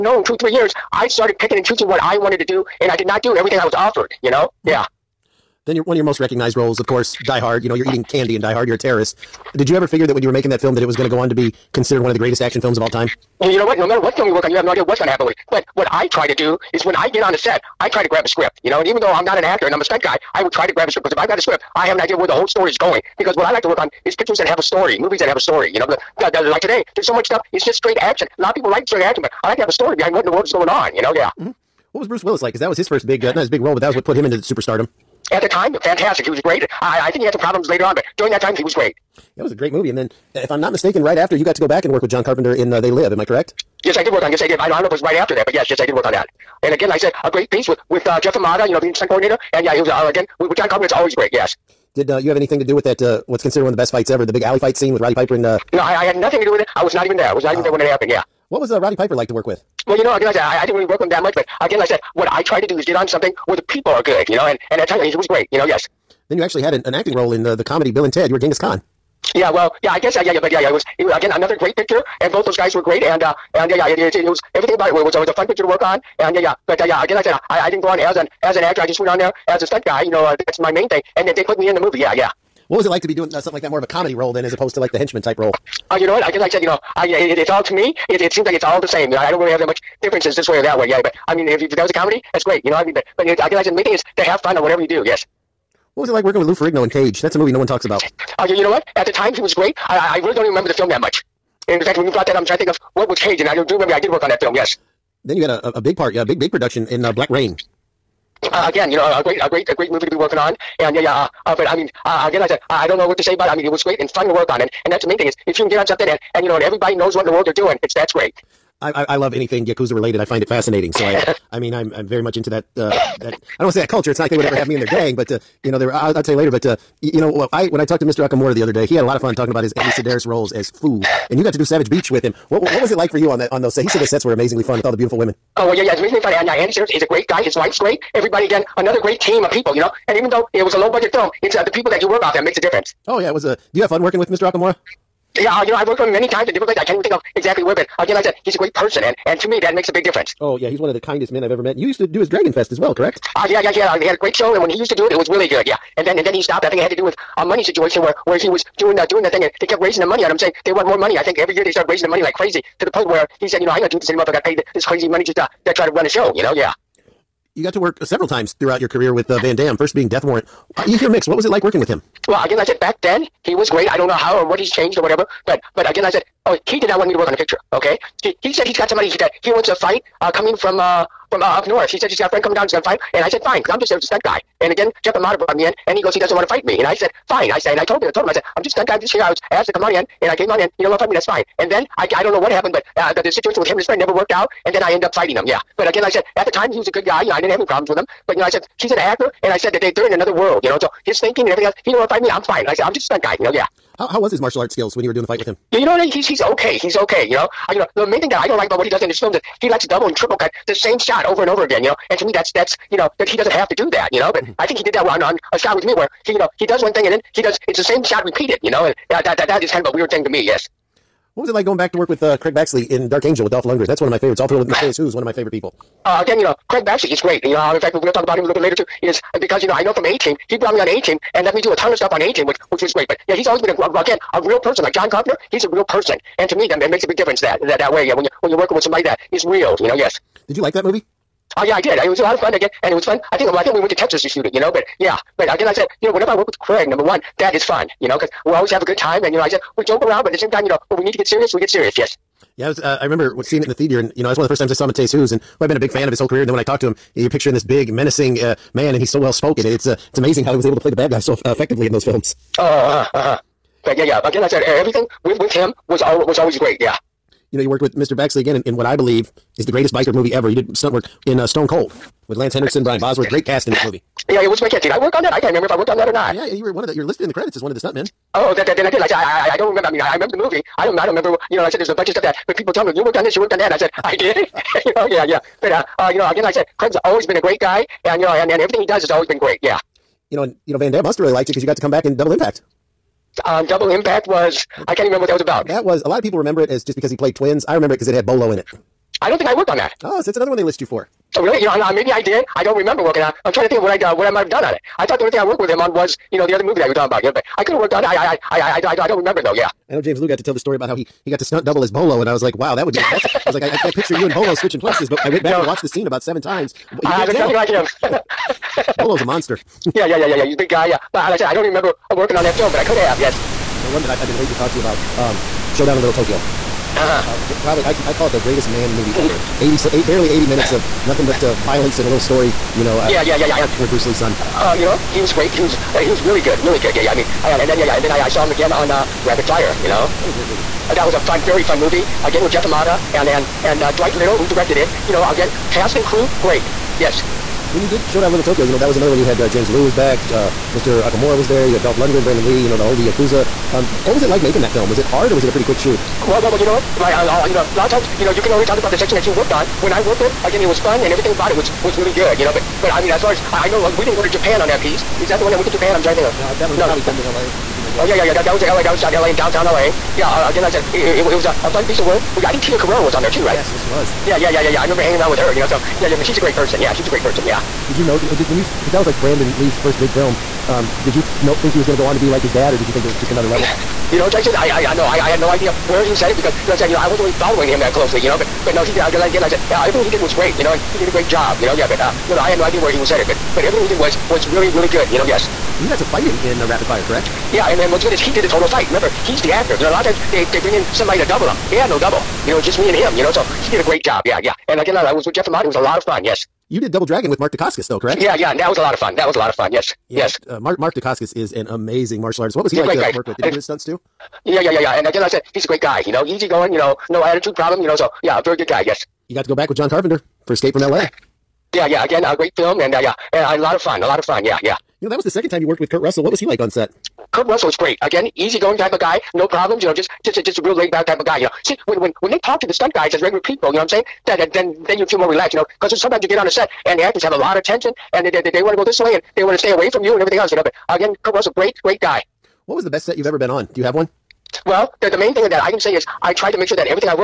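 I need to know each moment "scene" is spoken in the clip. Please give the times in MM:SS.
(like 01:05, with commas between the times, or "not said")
00:54, 05:15.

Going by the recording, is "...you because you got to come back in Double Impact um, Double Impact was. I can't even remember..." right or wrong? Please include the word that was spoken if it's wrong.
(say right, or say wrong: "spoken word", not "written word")
right.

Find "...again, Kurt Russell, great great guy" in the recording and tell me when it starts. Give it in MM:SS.
07:20.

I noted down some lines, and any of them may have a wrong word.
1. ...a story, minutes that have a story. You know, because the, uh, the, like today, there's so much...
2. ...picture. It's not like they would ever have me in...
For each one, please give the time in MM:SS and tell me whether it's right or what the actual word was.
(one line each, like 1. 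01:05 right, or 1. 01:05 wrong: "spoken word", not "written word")
1. 00:24 wrong: "movies", not "minutes"
2. 02:03 wrong: "culture", not "picture".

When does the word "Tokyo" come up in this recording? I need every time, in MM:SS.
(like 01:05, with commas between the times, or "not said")
05:26, 05:48.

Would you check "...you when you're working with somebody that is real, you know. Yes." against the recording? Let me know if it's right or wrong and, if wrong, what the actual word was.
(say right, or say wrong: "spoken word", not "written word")
right.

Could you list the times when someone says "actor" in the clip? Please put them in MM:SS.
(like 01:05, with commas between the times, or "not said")
00:19, 01:18, 03:18, 06:39, 07:17.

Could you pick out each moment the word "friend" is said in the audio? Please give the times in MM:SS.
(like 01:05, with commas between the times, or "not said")
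03:02, 03:13.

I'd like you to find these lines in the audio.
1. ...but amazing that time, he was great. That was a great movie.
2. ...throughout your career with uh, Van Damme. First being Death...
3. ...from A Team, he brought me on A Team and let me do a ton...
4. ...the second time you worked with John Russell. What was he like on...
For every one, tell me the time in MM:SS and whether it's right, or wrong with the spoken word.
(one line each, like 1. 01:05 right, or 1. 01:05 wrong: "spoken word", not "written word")
1. 00:37 wrong: "during", not "amazing"
2. 02:48 right
3. 03:49 right
4. 07:05 wrong: "Kurt", not "John".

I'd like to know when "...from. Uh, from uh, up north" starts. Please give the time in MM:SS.
03:00.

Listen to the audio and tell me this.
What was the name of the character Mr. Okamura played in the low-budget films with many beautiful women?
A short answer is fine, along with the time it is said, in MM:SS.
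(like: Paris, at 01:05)
Foo, at 02:10.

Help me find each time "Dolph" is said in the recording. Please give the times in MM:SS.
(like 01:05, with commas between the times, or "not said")
03:43, 05:51.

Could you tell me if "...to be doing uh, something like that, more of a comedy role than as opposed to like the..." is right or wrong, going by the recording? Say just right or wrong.
right.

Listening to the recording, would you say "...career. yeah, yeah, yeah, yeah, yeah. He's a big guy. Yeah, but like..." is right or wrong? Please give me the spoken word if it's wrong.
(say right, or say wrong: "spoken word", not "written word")
wrong: "monster", not "career".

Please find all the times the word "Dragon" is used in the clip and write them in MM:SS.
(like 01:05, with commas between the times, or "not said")
02:32, 06:47.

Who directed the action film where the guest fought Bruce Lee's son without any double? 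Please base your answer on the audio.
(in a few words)
Dwight Little.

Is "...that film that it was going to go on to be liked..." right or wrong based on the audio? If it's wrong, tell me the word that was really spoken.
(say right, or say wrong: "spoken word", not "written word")
wrong: "considered", not "liked".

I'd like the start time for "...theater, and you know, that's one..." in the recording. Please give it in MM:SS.
04:13.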